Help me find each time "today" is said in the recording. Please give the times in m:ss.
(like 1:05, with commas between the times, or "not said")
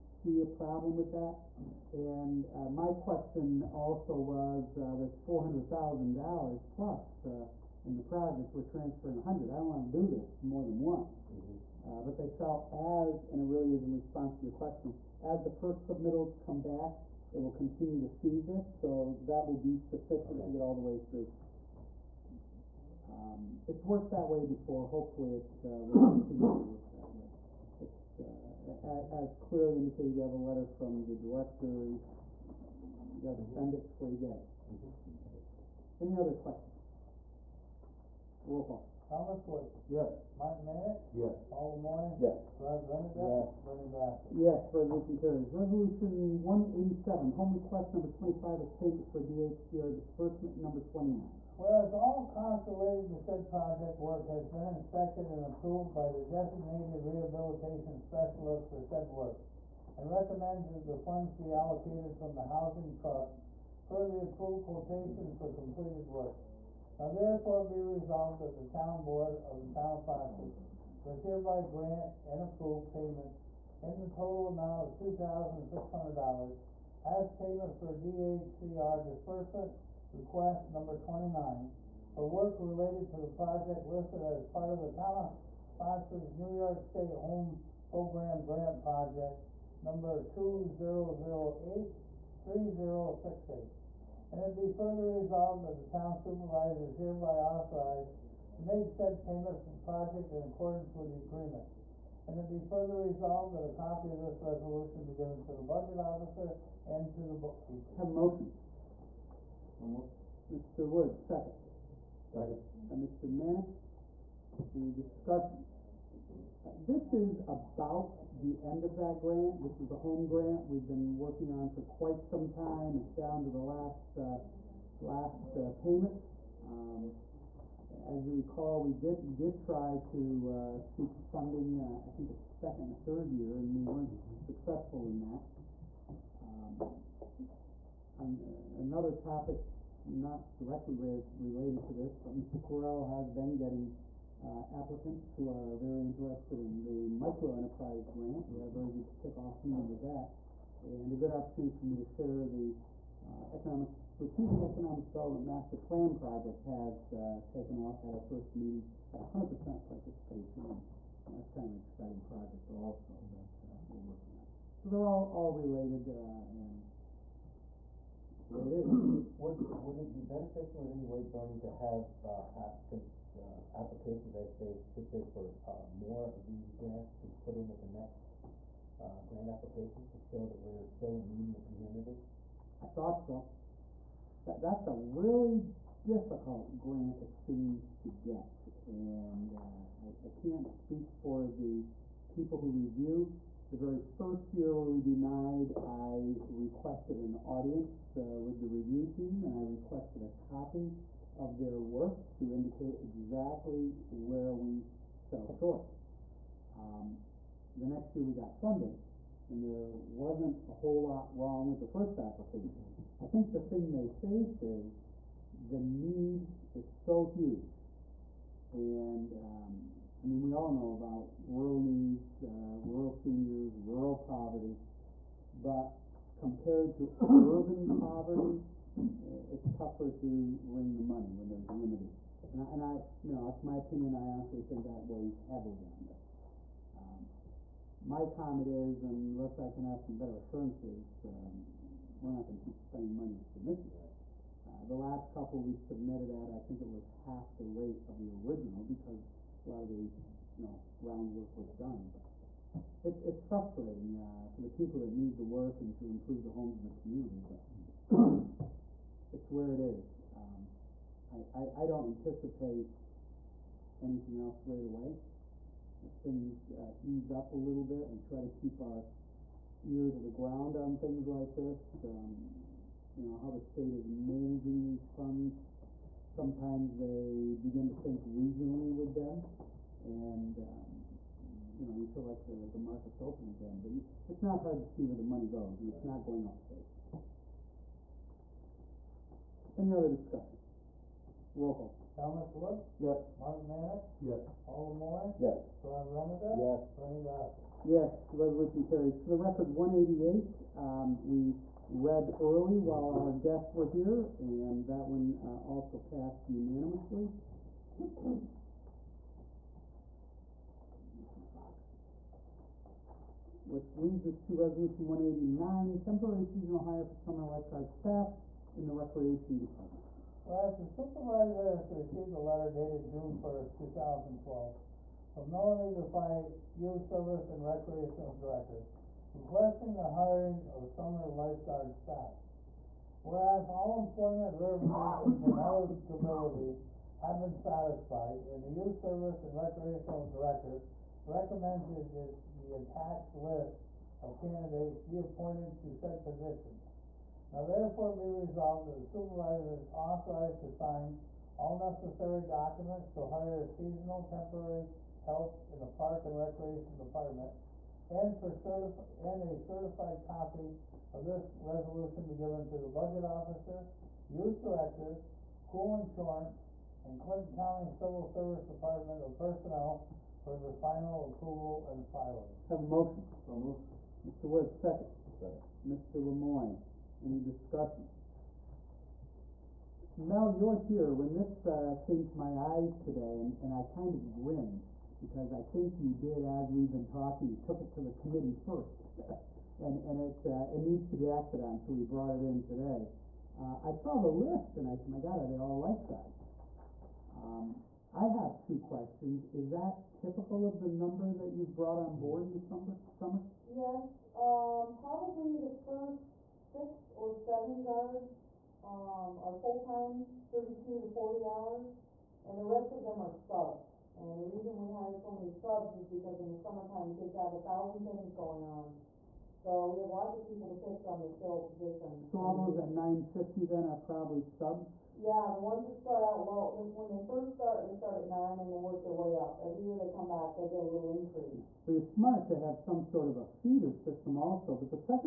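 6:23, 6:32.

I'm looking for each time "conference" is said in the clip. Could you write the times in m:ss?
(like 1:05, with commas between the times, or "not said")
not said.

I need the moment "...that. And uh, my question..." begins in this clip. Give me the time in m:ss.
0:01.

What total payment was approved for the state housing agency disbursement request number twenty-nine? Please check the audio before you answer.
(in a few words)
$2,600.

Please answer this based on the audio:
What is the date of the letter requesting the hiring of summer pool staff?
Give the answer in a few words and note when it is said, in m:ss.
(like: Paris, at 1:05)
June 1st, 2012, at 5:23.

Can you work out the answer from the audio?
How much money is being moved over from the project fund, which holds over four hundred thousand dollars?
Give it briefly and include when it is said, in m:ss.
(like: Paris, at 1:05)
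$100,000, at 0:09.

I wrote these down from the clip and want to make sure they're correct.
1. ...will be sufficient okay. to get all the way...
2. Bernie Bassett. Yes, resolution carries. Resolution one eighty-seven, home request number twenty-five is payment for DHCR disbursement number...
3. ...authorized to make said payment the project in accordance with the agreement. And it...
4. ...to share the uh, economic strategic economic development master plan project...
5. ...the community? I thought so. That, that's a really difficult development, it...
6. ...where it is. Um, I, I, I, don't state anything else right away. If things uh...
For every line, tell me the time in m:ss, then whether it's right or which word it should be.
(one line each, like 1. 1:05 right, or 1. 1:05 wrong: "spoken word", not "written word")
1. 0:19 right
2. 0:43 right
3. 1:37 right
4. 2:31 right
5. 3:01 wrong: "grant", not "development"
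6. 4:19 wrong: "anticipate", not "state".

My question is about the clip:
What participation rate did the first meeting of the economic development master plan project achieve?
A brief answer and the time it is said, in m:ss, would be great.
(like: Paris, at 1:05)
100%, at 2:39.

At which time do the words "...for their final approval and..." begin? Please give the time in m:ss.
6:10.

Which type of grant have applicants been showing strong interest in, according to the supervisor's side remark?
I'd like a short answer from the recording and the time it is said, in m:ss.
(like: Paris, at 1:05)
micro enterprise grant, at 2:27.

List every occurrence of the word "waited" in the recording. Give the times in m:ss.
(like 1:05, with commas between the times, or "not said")
not said.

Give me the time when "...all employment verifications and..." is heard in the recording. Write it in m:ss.
5:33.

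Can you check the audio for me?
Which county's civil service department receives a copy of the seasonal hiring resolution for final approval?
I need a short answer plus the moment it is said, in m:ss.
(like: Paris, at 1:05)
Clinton County, at 6:07.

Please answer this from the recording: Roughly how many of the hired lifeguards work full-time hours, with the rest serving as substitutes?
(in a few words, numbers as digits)
6 or 7.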